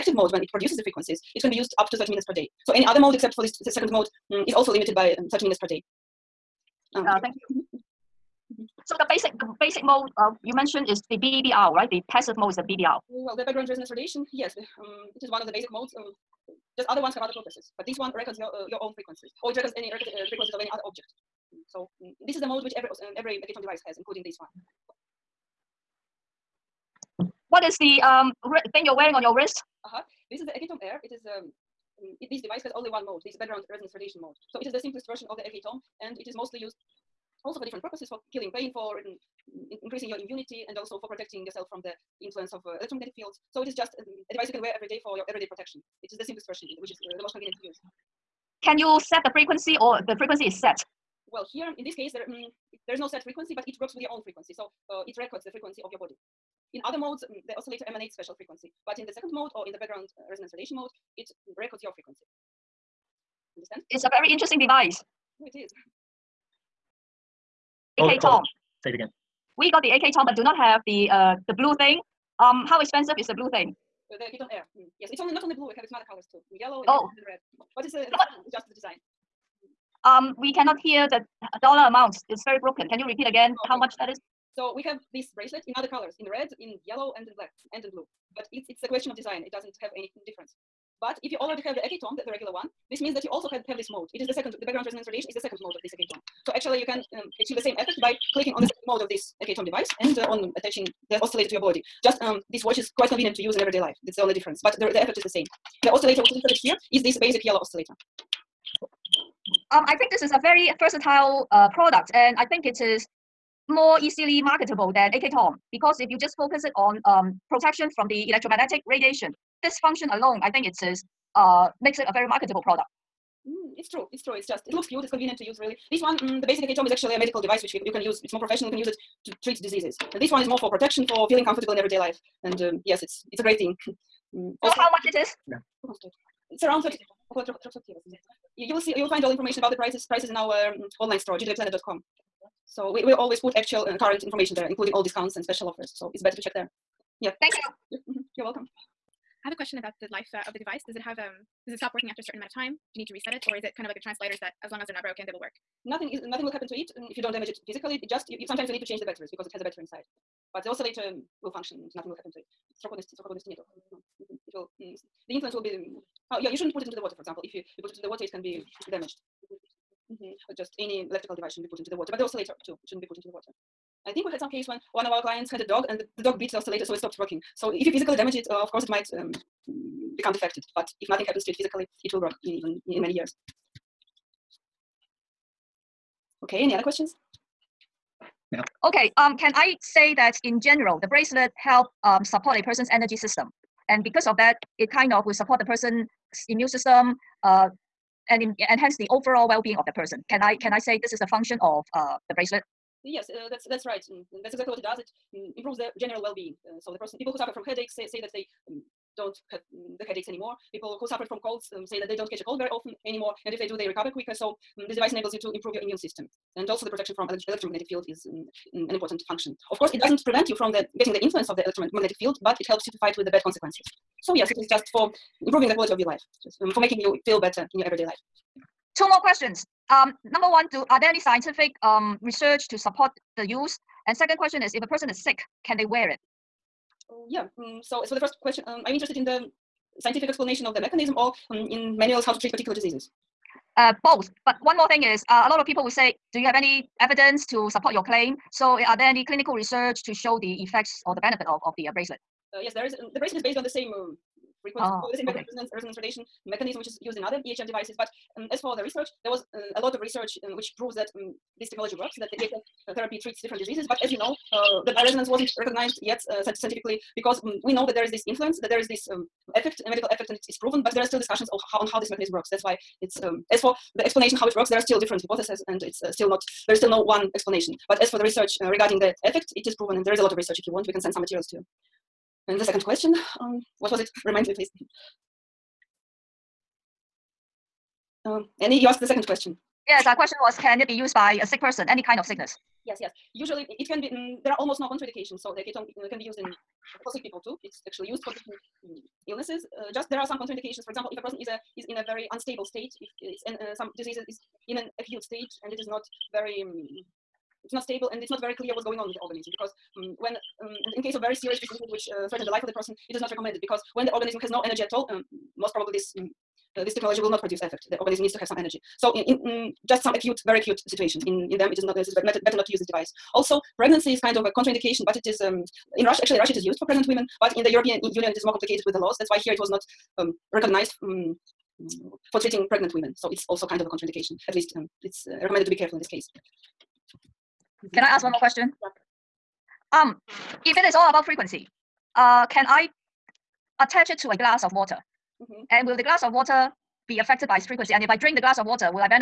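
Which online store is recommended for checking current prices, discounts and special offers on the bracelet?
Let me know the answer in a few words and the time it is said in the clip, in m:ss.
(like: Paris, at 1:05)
gdvplanet.com, at 2:21.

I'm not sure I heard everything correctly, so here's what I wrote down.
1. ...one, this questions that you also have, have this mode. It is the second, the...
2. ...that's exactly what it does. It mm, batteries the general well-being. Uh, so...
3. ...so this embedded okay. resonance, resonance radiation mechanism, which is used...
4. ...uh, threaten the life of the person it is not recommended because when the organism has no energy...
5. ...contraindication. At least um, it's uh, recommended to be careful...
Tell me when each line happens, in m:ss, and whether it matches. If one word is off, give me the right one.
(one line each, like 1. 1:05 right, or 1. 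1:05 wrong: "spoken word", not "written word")
1. 1:32 wrong: "means", not "questions"
2. 3:24 wrong: "improves", not "batteries"
3. 4:15 right
4. 5:12 right
5. 5:33 right.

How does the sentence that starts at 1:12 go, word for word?
Um, how expensive is the blue thing?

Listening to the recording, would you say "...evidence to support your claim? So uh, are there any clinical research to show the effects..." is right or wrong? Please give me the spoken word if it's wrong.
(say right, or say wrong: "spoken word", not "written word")
right.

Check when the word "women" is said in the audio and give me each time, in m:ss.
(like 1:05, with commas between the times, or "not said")
5:27, 5:32.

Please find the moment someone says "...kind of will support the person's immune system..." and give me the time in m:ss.
3:14.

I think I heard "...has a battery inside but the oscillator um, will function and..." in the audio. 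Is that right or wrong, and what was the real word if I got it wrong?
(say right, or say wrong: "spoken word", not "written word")
right.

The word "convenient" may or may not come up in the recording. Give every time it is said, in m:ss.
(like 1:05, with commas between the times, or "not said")
0:47, 1:43, 2:05.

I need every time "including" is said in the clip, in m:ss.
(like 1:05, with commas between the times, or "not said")
0:23, 2:24.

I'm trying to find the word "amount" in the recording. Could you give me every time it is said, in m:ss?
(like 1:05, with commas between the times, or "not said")
1:21, 2:32.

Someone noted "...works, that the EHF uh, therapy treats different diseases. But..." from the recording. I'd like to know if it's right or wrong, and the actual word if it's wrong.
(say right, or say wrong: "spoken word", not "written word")
right.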